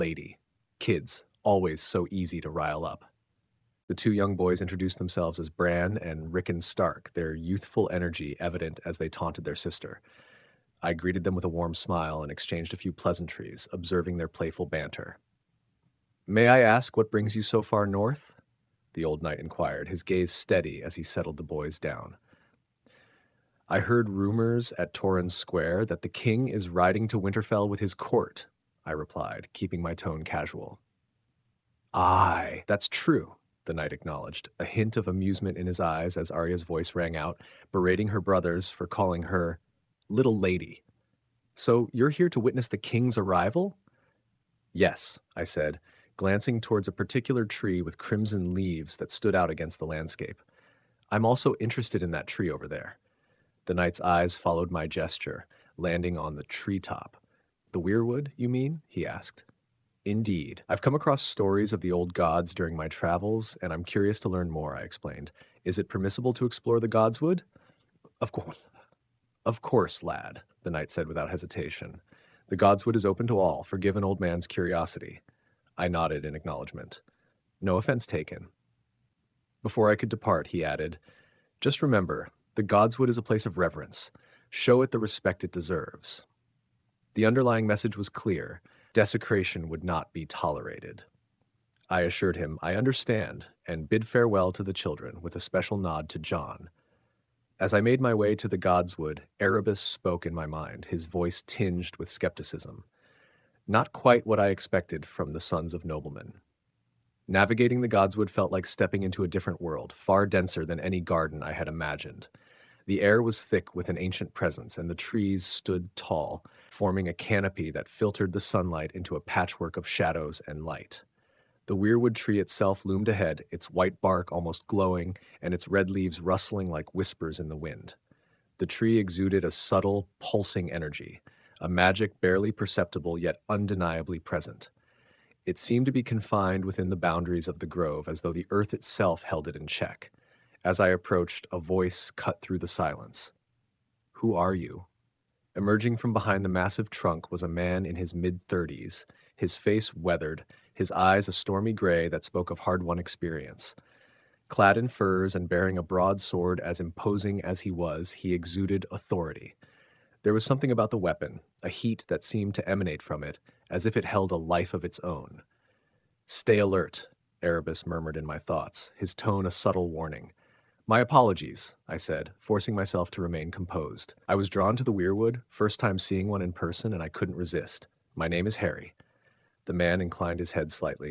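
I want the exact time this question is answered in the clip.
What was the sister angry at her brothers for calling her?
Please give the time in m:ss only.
0:40.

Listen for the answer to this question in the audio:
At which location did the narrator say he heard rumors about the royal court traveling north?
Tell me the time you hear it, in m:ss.
0:24.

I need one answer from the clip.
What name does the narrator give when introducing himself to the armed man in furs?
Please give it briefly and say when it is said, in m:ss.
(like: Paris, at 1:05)
Harry, at 2:58.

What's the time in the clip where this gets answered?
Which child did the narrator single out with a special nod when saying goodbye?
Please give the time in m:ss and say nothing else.
1:36.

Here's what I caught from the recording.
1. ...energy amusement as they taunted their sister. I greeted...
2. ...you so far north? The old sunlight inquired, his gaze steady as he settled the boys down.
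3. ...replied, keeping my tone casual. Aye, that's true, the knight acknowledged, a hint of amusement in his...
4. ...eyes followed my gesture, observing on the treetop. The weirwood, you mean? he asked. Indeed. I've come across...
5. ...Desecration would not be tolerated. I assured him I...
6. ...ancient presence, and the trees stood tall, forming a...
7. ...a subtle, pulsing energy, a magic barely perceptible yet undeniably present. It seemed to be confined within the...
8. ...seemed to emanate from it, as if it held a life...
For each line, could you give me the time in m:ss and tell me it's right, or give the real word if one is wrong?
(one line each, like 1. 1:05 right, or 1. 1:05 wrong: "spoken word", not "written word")
1. 0:07 wrong: "evident", not "amusement"
2. 0:17 wrong: "knight", not "sunlight"
3. 0:28 right
4. 0:54 wrong: "landing", not "observing"
5. 1:28 right
6. 1:53 right
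7. 2:09 right
8. 2:42 right.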